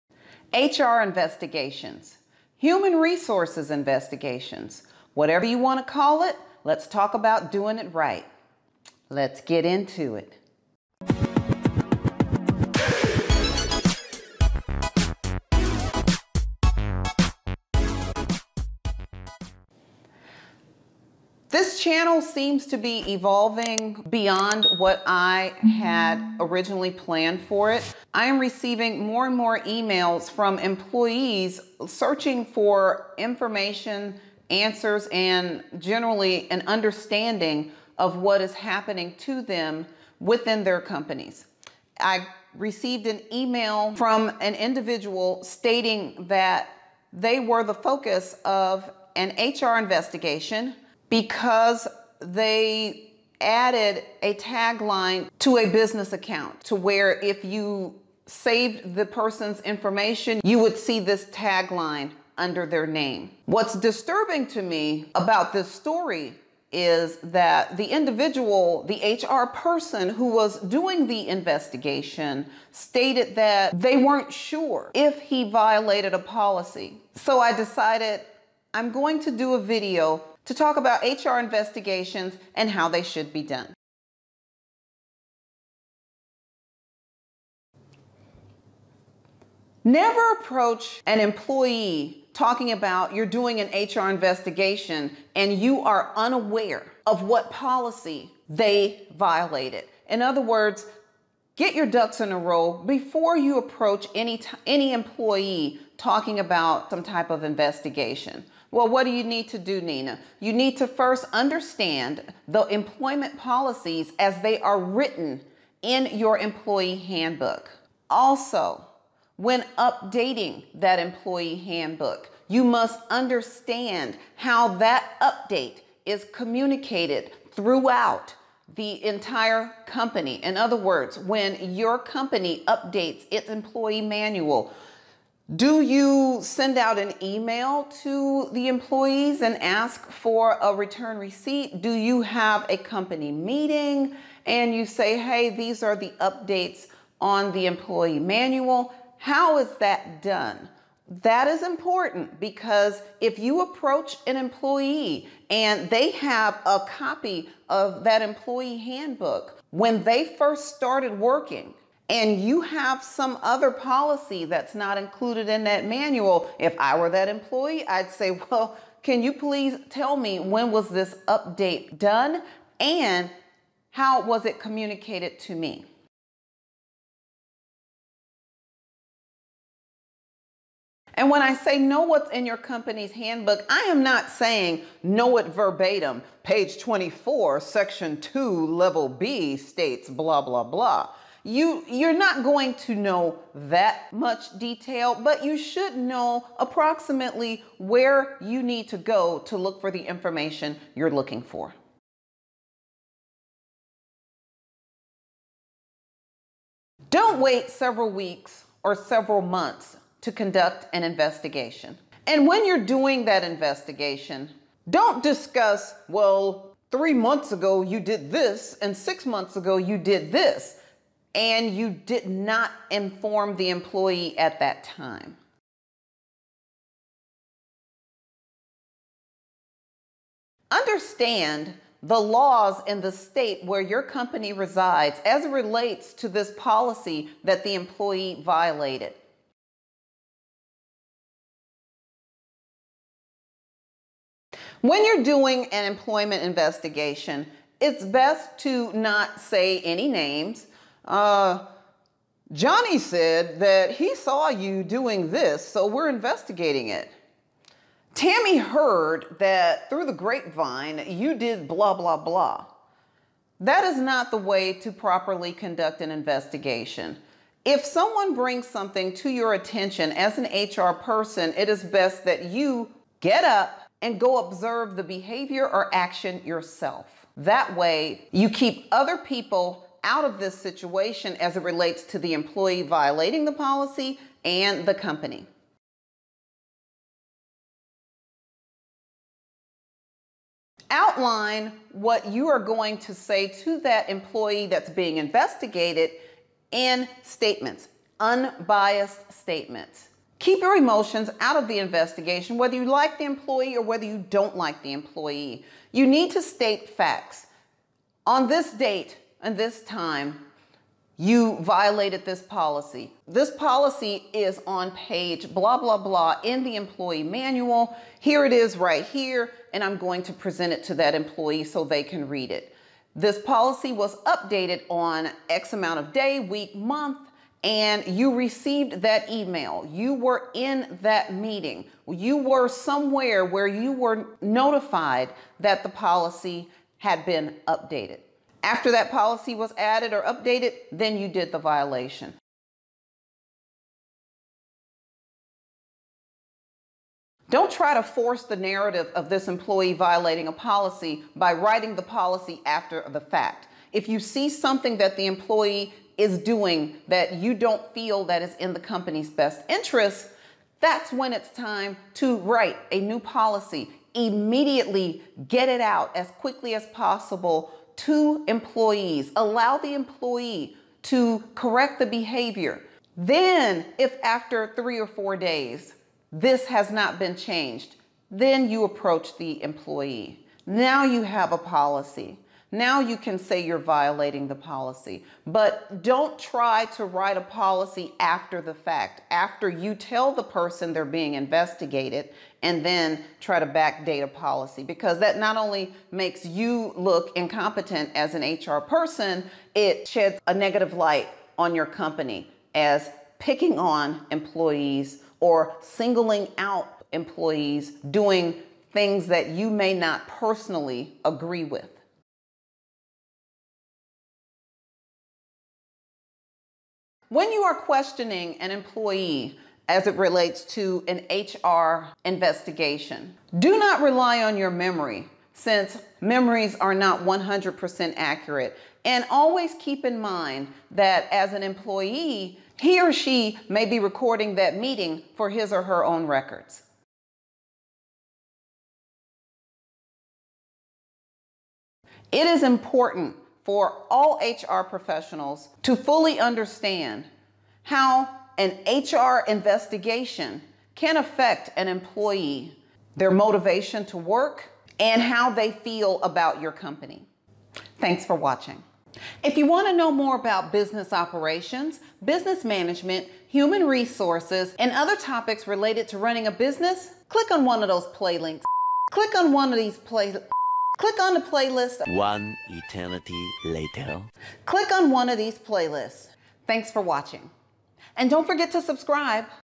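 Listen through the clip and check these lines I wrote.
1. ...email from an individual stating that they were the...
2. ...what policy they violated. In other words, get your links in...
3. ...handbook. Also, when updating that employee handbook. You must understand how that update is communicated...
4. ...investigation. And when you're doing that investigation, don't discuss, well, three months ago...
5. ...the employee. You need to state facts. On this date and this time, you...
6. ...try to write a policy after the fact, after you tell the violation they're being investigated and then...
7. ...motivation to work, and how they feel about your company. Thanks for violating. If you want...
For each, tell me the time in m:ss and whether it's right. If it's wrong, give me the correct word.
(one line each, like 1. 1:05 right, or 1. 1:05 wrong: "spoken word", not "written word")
1. 0:43 right
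2. 1:37 wrong: "ducks", not "links"
3. 1:56 right
4. 3:31 right
5. 5:04 right
6. 6:26 wrong: "person", not "violation"
7. 7:33 wrong: "watching", not "violating".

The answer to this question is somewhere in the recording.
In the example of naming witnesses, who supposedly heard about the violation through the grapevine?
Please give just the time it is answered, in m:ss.
4:18.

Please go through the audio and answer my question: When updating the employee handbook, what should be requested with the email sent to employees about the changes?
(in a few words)
a return receipt.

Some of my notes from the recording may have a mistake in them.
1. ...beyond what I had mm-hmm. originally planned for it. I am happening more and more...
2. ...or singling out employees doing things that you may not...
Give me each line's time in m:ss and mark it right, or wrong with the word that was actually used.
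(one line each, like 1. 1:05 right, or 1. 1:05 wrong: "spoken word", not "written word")
1. 0:24 wrong: "receiving", not "happening"
2. 6:45 right.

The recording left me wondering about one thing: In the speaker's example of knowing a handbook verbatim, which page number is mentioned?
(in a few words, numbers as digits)
24.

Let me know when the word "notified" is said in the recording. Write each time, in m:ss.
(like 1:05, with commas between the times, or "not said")
5:34.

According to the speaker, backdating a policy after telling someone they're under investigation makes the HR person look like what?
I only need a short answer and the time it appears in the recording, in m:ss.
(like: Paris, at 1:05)
incompetent, at 6:37.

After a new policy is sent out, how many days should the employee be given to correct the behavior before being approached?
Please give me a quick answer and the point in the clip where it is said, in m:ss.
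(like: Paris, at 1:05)
3 or 4 days, at 6:14.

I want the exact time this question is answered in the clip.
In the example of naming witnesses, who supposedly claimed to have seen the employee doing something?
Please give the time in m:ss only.
4:12.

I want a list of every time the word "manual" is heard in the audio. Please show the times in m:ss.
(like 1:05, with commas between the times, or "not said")
2:14, 2:28, 2:45, 5:17.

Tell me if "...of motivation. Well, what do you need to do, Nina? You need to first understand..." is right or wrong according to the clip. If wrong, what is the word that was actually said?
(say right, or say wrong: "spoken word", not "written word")
wrong: "investigation", not "motivation".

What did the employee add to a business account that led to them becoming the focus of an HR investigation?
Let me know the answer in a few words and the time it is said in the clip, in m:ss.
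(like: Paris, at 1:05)
a tagline, at 0:54.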